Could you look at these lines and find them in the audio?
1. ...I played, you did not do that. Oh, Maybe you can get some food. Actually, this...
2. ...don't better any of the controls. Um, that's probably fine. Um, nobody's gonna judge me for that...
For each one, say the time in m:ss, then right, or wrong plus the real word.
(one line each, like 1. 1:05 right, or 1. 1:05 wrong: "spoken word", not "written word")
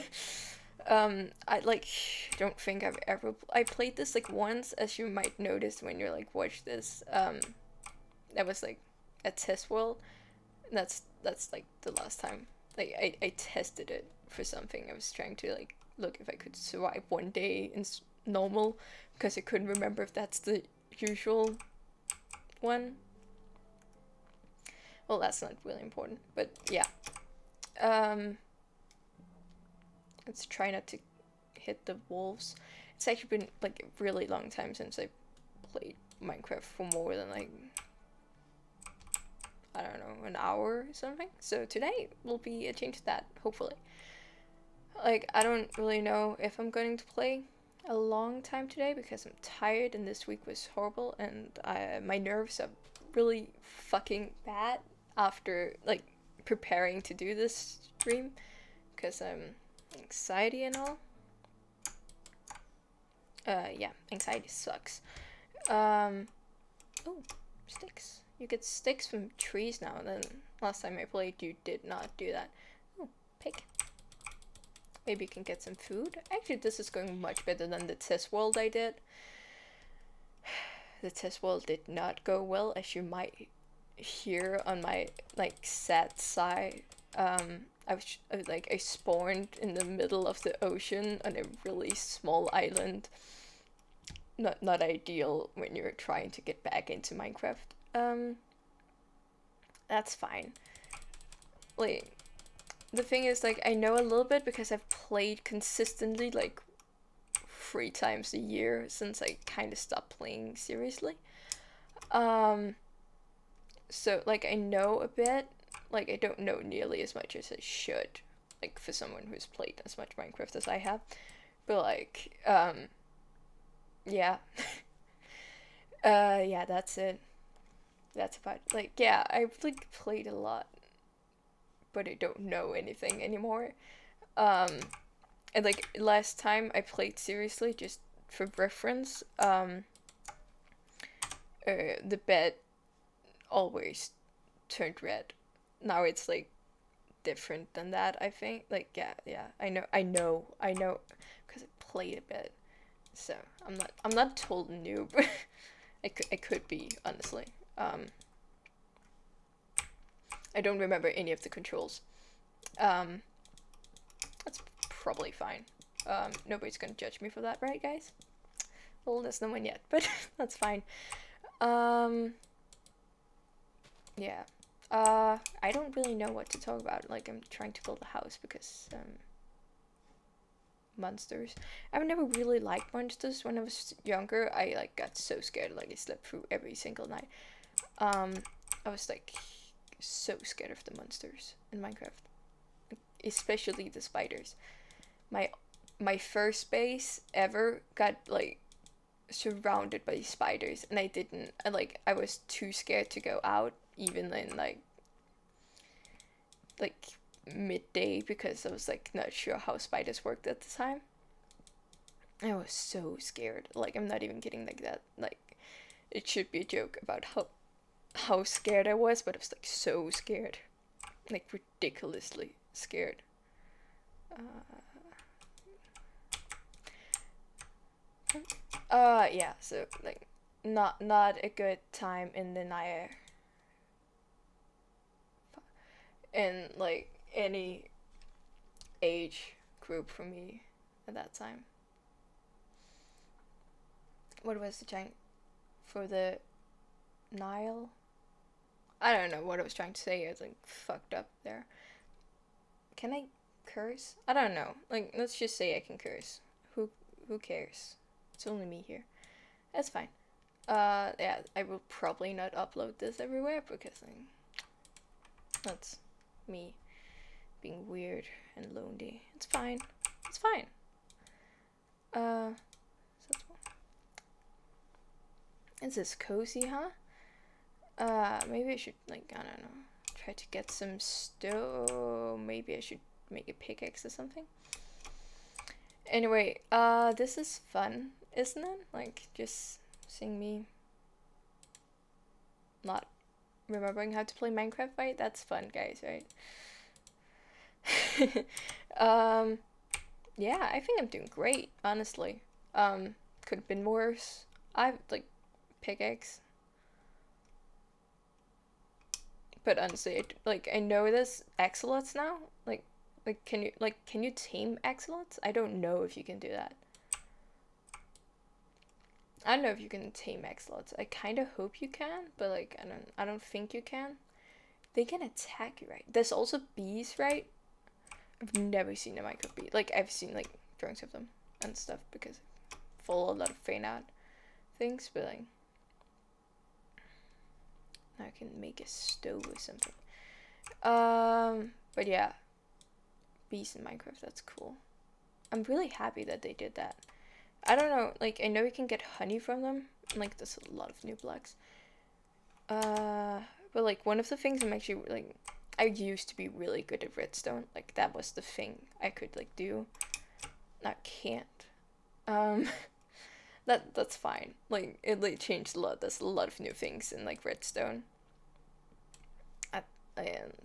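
1. 1:11 right
2. 2:40 wrong: "remember", not "better".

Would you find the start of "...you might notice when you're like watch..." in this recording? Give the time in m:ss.
0:04.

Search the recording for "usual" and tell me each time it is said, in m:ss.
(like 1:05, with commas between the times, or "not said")
0:20.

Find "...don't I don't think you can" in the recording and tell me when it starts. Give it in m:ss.
5:22.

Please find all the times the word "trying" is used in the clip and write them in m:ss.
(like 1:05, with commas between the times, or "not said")
0:15, 1:35, 2:57, 4:09.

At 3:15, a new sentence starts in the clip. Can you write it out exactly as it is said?
My my first base ever got like surrounded by spiders, and I didn't.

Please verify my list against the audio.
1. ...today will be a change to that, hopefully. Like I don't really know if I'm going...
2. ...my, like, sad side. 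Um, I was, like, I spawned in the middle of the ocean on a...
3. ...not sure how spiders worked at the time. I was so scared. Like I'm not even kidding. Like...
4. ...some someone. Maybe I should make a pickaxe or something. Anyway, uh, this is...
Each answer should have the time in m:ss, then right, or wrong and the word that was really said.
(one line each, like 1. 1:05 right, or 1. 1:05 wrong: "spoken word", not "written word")
1. 0:41 right
2. 1:24 right
3. 3:29 right
4. 4:40 wrong: "stone", not "someone".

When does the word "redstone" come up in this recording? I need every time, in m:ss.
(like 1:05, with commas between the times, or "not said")
5:57, 6:07.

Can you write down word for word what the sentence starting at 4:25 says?
that's me being weird and lonely.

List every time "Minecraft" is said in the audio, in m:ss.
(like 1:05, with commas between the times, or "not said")
0:36, 1:37, 2:00, 3:11, 4:54, 5:43.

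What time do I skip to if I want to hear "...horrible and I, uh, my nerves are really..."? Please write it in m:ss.
0:50.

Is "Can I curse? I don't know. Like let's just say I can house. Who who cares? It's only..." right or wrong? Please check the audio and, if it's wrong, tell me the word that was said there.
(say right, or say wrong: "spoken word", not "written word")
wrong: "curse", not "house".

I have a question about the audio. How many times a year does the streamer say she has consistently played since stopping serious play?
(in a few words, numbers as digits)
3.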